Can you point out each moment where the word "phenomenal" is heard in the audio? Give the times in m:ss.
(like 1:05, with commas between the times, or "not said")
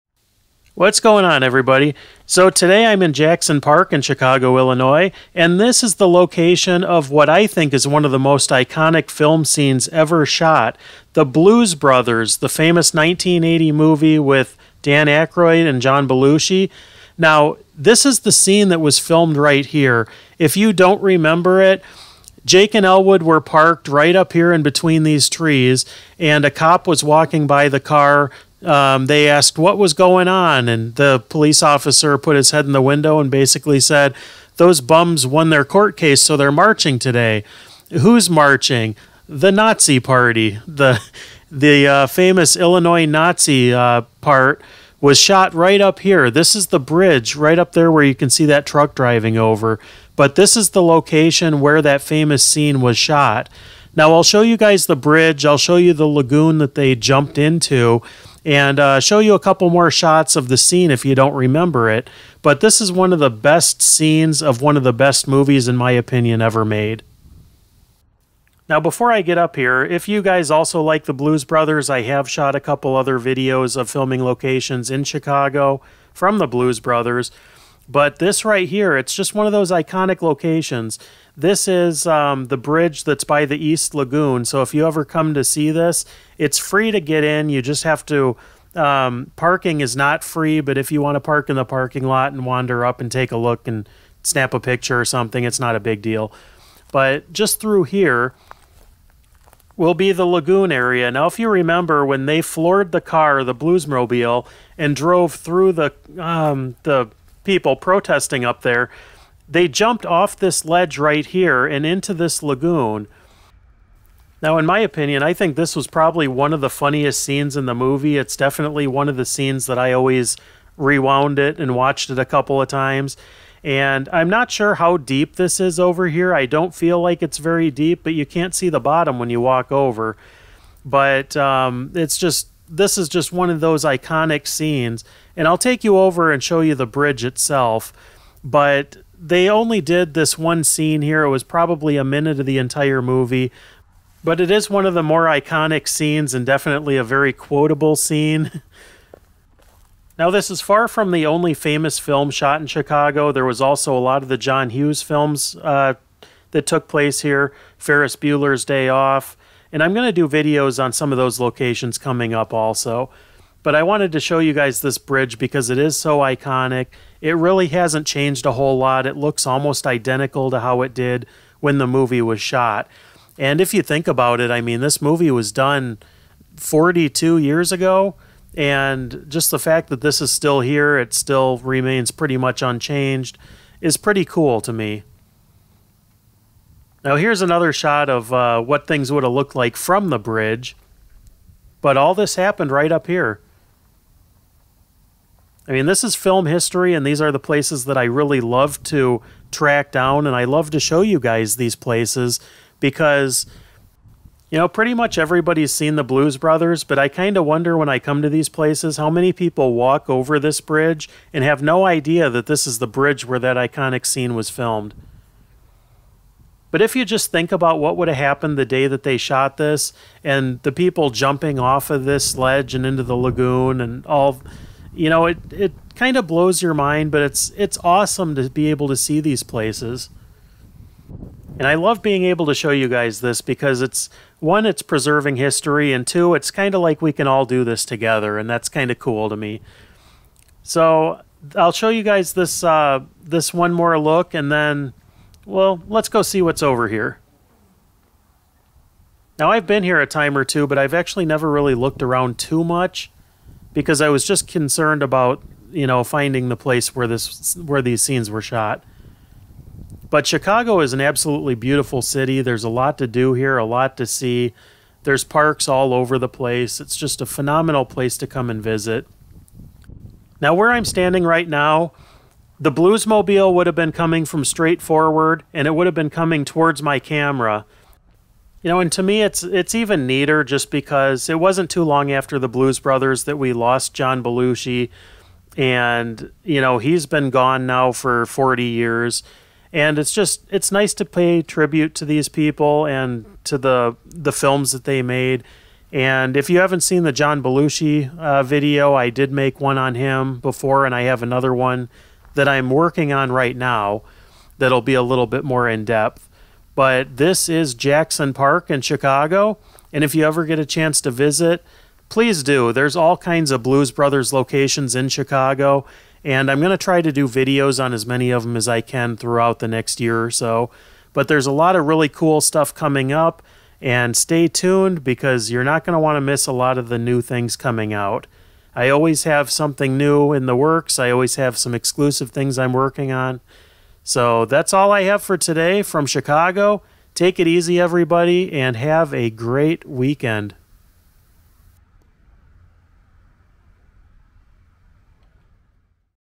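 4:27.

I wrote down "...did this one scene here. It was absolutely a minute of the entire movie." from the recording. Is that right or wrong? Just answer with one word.
wrong.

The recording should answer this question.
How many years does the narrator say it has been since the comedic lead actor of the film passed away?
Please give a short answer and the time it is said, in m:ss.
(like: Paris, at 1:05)
40, at 4:48.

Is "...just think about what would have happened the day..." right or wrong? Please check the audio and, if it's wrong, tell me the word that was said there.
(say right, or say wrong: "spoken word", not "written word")
right.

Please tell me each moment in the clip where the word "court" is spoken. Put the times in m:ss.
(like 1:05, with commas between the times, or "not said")
0:35.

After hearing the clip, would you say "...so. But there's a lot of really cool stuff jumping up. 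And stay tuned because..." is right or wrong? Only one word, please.
wrong.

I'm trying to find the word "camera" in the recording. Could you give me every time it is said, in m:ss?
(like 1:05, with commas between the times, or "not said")
4:36.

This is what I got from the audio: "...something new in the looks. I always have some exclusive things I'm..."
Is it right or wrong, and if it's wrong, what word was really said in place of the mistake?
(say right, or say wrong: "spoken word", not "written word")
wrong: "works", not "looks".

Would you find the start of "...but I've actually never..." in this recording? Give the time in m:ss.
4:10.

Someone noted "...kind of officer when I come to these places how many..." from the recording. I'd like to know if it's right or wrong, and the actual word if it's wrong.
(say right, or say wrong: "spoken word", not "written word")
wrong: "wonder", not "officer".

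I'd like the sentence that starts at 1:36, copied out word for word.
But just through here, will be the lagoon area.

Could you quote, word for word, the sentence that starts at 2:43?
But I wanted to show you guys this bridge because it is so iconic.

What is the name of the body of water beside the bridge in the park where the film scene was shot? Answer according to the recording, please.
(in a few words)
East Lagoon.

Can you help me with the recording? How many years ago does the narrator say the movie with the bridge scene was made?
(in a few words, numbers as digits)
42.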